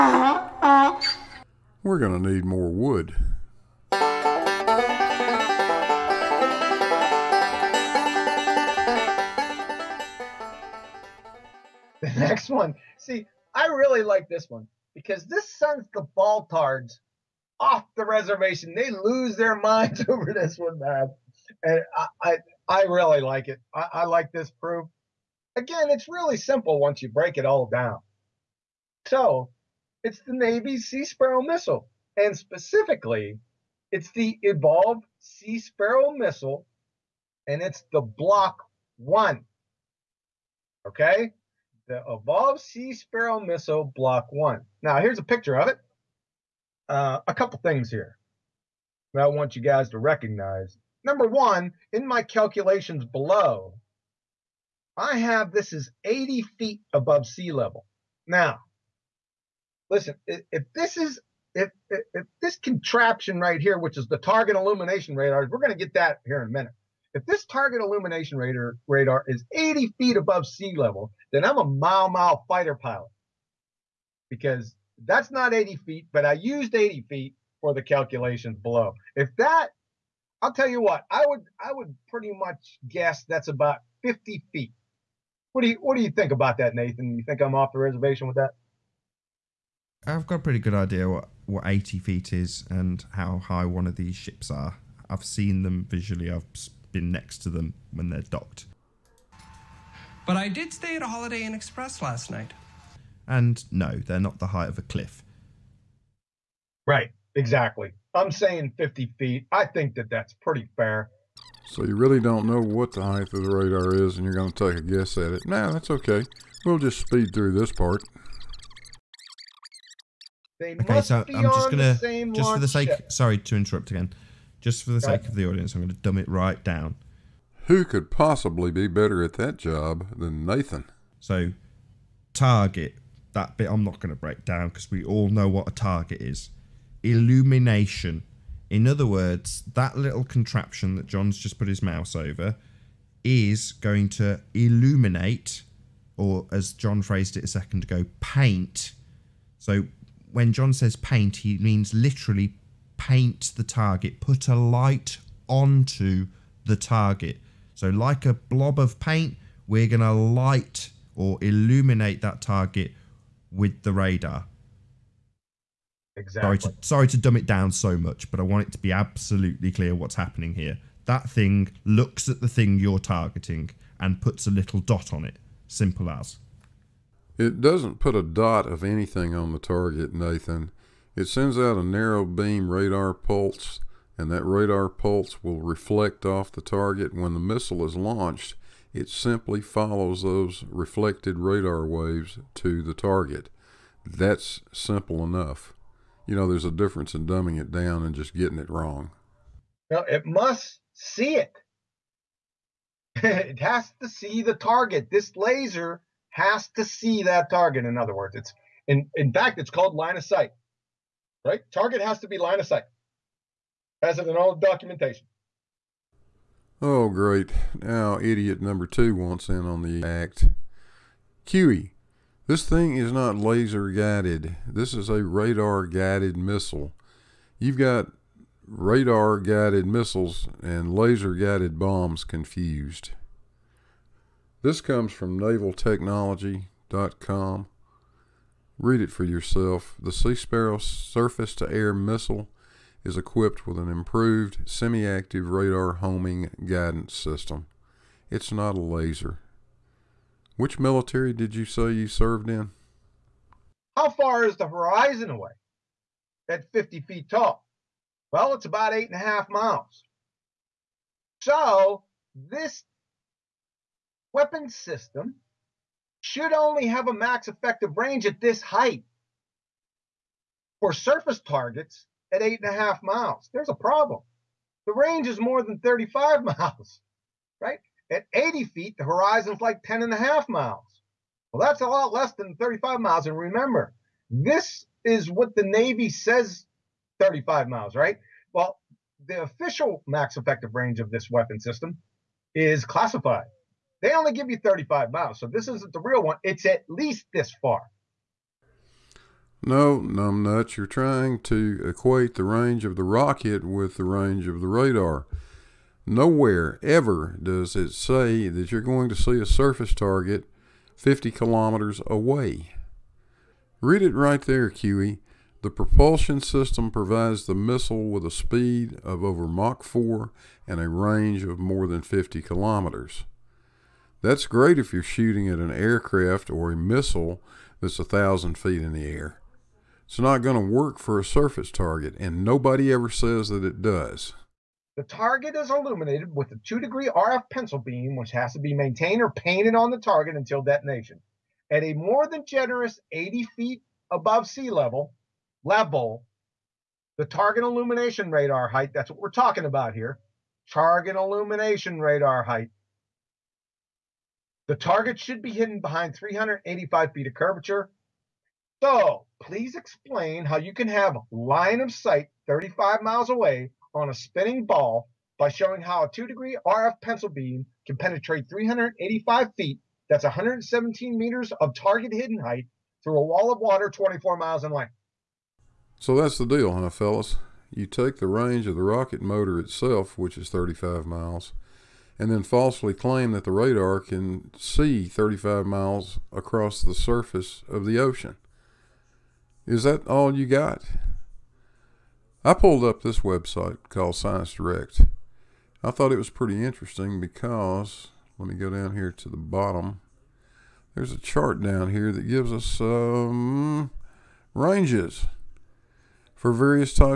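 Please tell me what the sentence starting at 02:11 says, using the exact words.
So, target that bit I'm not going to break down because we all know what a target is illumination.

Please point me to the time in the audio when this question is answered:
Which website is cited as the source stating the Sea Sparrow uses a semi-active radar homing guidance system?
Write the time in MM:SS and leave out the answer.
03:55.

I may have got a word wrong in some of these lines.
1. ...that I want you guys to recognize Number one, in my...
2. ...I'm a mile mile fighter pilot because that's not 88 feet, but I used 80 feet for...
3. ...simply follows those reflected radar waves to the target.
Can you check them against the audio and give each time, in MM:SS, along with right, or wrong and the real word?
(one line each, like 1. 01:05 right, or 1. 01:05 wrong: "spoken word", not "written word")
1. 00:49 right
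2. 01:11 wrong: "80", not "88"
3. 03:09 right.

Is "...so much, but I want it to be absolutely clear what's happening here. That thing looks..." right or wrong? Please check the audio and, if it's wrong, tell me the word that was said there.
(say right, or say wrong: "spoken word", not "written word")
right.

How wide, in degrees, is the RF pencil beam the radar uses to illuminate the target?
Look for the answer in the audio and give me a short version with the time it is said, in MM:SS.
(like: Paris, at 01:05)
2 degrees, at 05:36.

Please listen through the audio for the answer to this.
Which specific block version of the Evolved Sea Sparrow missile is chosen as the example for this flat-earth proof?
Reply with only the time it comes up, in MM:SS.
00:37.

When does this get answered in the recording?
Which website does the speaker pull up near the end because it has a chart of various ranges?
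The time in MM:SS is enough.
06:34.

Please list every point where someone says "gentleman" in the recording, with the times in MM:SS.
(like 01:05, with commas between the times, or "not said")
not said.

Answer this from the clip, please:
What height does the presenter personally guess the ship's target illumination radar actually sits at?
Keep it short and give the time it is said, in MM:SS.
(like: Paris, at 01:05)
50 feet, at 01:23.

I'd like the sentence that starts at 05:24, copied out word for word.
That's great if you're shooting at an aircraft or a missile that's a thousand feet in the air.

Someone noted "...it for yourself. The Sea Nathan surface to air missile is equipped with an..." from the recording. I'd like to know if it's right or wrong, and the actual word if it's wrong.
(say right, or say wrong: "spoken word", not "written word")
wrong: "Sparrow", not "Nathan".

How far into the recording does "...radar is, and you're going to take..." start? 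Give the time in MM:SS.
01:53.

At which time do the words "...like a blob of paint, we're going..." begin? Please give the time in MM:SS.
02:37.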